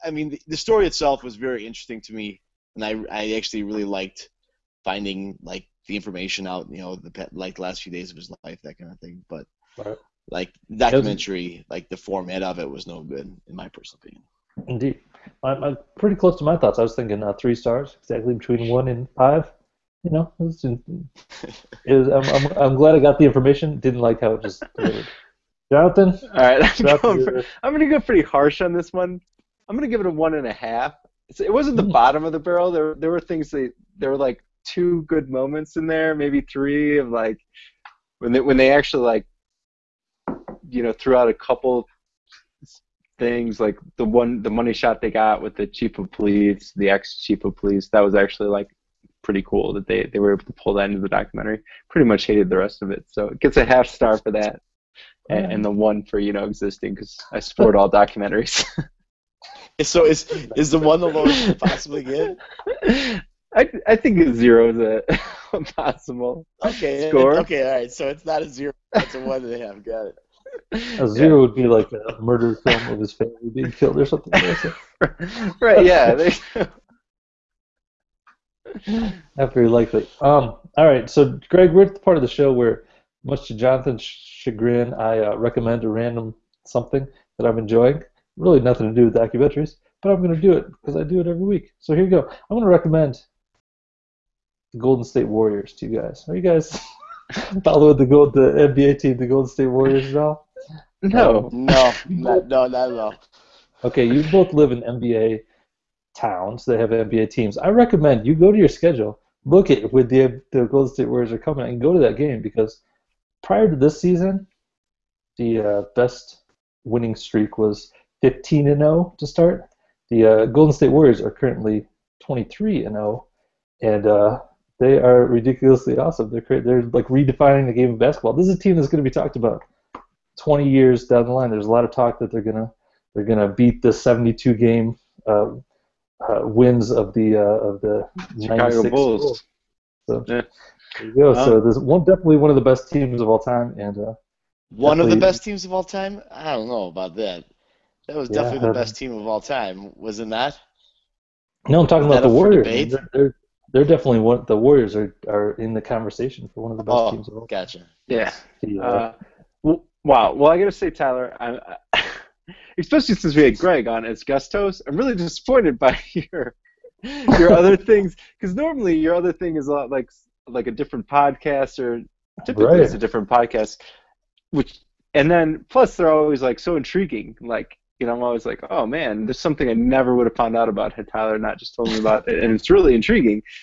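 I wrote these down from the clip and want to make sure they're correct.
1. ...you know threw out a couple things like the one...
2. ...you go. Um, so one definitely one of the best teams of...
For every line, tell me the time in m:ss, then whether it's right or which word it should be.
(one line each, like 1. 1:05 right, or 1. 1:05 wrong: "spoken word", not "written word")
1. 0:40 right
2. 2:21 right.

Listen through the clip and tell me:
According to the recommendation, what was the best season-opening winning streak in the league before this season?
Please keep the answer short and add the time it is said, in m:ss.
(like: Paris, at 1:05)
15 and 0, at 1:58.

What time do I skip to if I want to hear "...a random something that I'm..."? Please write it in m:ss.
1:25.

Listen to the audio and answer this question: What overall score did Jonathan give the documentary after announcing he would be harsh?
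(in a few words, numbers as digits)
1.5.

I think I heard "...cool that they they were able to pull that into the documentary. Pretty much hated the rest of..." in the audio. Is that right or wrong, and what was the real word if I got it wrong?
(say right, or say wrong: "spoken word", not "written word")
right.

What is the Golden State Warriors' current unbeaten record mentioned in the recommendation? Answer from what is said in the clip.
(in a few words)
23 and 0.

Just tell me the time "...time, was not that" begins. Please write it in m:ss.
2:29.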